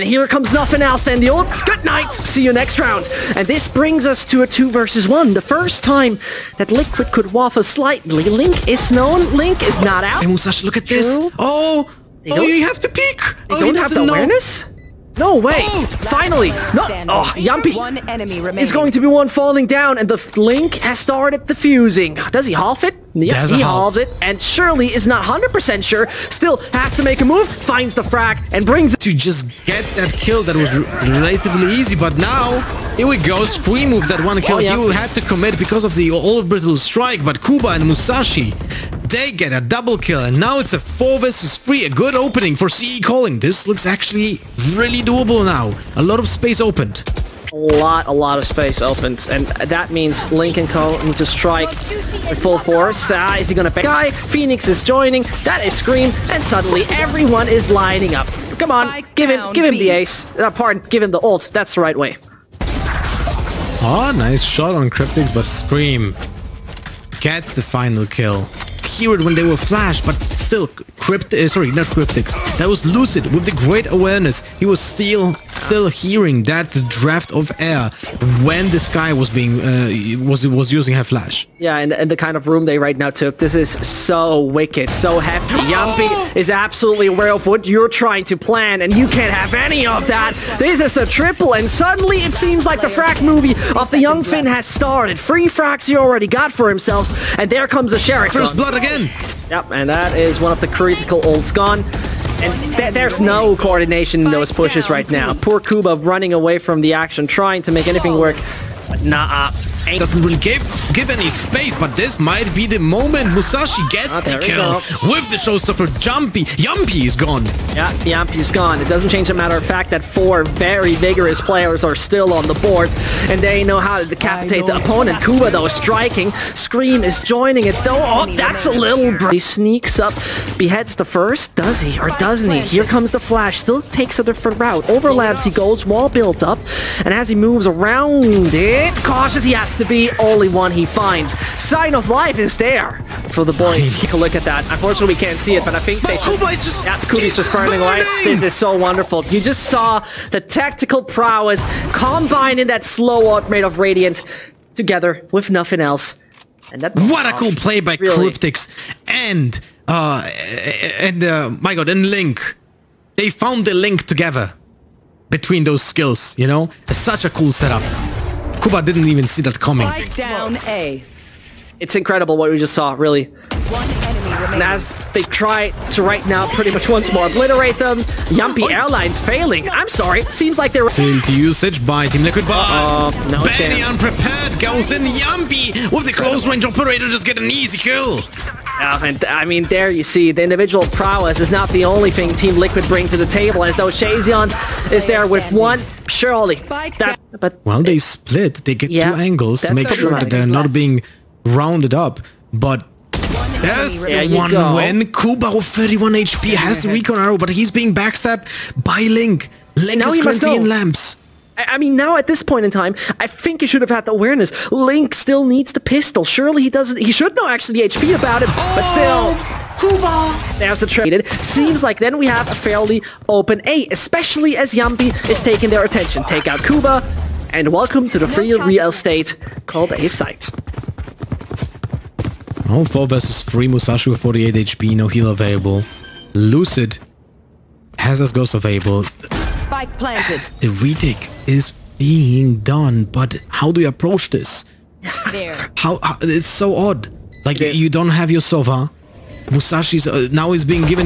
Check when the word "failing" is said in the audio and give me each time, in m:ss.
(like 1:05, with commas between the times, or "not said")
2:59.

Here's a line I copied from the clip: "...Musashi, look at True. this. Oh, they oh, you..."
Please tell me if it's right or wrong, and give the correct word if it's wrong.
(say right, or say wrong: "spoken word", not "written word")
right.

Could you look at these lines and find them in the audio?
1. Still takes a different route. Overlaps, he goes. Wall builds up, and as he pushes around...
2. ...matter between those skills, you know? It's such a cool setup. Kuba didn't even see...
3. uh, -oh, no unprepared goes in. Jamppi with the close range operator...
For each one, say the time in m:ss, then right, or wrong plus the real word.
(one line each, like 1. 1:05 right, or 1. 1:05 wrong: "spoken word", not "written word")
1. 2:13 wrong: "moves", not "pushes"
2. 2:44 wrong: "together", not "matter"
3. 3:03 right.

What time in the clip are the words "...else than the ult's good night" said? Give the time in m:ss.
0:00.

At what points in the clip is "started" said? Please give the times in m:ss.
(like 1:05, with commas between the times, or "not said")
0:20, 1:34.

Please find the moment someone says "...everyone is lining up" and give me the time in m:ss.
0:56.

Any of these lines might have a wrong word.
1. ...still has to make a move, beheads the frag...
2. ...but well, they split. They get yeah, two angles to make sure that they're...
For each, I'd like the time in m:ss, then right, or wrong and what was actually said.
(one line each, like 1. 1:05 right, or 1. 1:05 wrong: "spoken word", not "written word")
1. 0:26 wrong: "finds", not "beheads"
2. 3:17 right.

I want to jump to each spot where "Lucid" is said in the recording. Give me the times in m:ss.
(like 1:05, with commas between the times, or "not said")
1:12, 3:56.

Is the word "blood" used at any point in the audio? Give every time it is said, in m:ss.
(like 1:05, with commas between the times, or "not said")
1:38.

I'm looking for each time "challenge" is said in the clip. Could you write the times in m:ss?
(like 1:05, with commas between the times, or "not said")
not said.